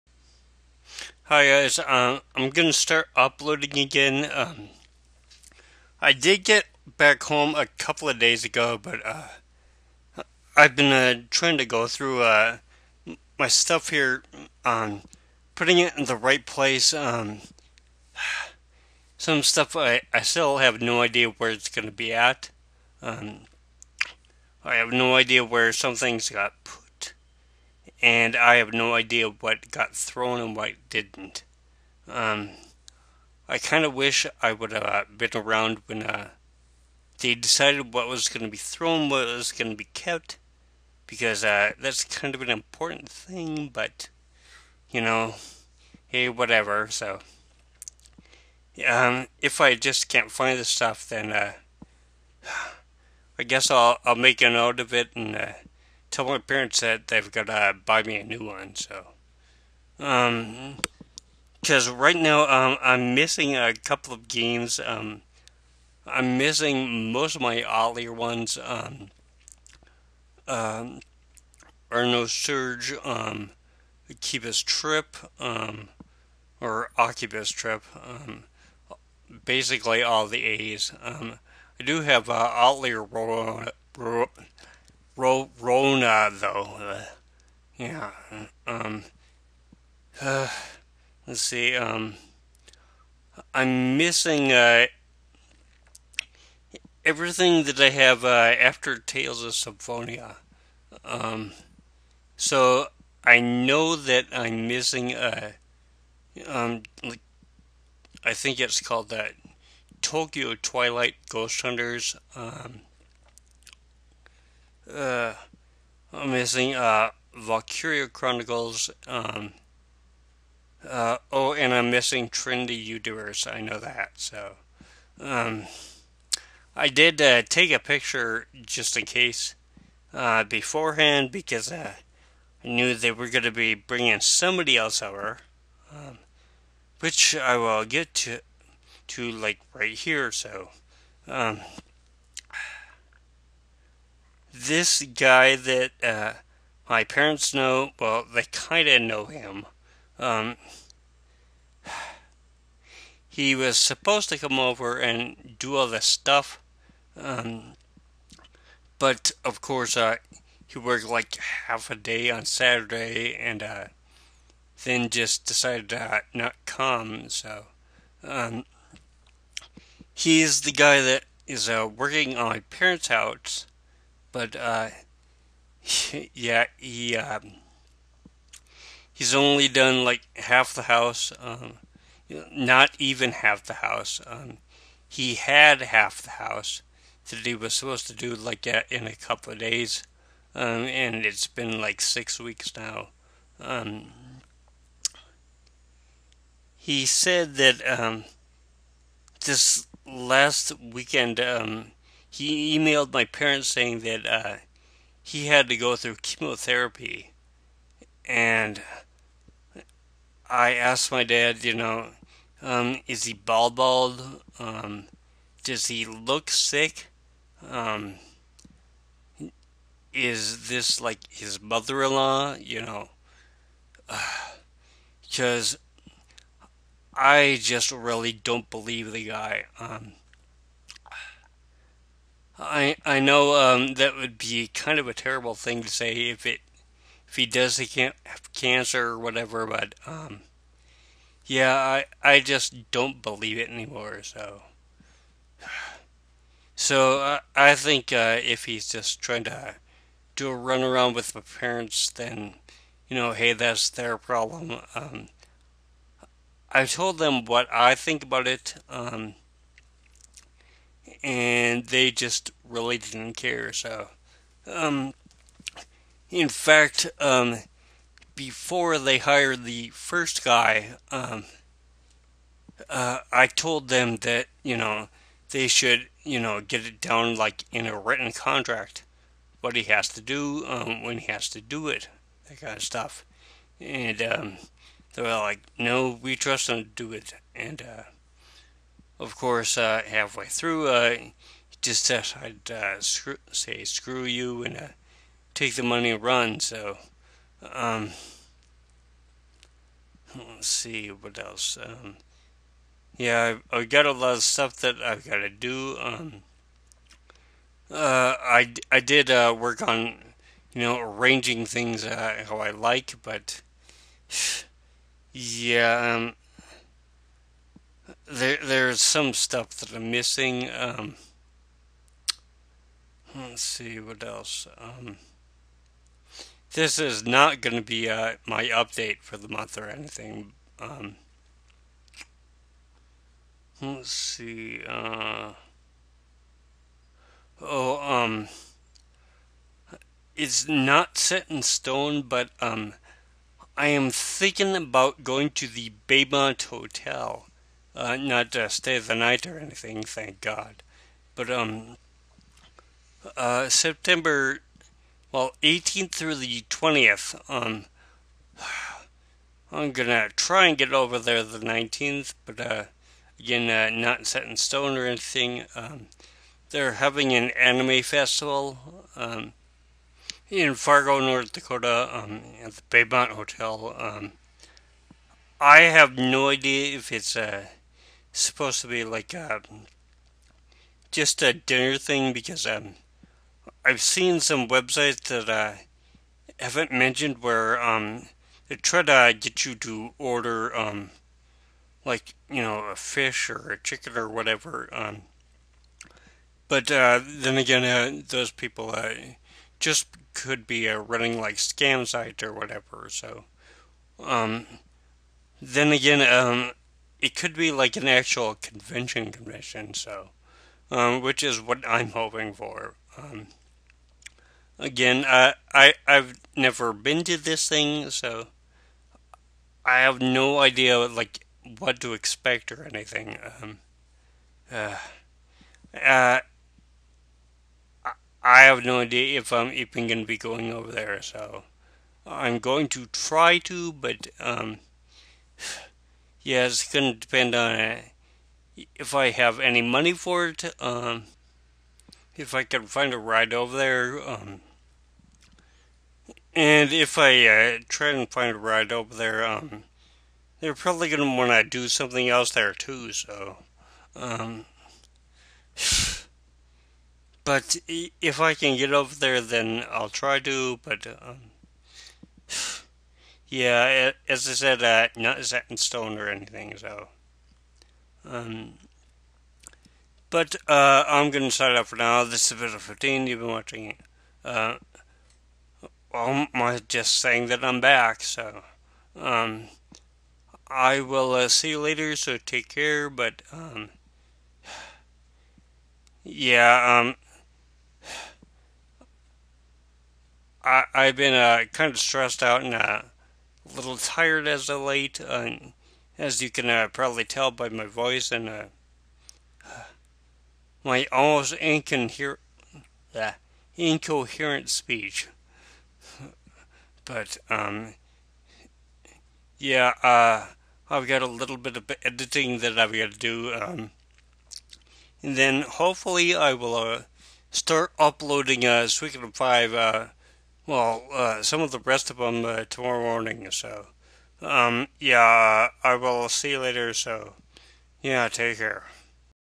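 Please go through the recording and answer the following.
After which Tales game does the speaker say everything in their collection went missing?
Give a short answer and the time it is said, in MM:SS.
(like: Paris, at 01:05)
Tales of Symphonia, at 01:38.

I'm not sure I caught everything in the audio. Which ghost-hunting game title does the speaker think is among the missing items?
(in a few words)
Tokyo Twilight Ghost Hunters.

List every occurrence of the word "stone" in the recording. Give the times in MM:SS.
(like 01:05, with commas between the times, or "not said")
05:41, 06:04, 07:45.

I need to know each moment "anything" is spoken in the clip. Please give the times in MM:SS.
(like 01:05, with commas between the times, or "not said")
05:29, 05:49, 06:05, 07:02, 07:46.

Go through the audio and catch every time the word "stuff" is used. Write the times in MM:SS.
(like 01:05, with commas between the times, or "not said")
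00:13, 00:19, 00:50, 02:36, 04:42, 05:04, 05:19.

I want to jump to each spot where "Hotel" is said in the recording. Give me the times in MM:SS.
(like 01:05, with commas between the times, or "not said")
05:46, 06:13.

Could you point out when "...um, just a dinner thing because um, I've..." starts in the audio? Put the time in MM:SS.
06:19.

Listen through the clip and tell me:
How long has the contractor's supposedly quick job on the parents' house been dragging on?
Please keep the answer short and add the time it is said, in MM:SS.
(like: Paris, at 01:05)
six weeks, at 03:12.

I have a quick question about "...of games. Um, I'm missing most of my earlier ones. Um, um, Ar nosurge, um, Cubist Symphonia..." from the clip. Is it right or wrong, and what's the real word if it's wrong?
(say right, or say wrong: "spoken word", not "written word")
wrong: "Trip", not "Symphonia".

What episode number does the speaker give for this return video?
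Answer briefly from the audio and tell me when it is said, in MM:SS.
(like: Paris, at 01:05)
15, at 07:52.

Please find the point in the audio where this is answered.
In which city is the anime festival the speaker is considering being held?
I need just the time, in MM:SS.
06:10.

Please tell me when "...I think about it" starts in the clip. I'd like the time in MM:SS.
04:17.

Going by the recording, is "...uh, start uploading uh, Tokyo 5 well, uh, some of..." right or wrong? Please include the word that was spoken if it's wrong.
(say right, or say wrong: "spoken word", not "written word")
wrong: "Suikoden", not "Tokyo".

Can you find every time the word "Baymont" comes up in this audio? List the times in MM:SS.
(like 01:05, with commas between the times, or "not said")
05:46, 06:12.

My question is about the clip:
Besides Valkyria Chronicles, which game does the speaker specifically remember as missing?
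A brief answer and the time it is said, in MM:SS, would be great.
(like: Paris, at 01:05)
Trinity Universe, at 02:02.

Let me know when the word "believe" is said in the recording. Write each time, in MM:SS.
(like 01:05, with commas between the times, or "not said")
03:48, 04:03.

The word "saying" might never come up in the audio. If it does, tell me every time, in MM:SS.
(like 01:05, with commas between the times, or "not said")
03:23, 07:57.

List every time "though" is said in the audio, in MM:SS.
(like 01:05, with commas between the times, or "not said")
01:26.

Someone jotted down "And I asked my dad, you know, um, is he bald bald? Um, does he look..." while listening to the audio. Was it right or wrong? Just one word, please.
right.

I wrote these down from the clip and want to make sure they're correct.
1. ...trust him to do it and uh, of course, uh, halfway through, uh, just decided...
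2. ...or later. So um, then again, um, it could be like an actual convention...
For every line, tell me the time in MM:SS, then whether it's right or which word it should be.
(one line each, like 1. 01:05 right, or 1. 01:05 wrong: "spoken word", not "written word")
1. 04:46 right
2. 06:42 wrong: "whatever", not "later".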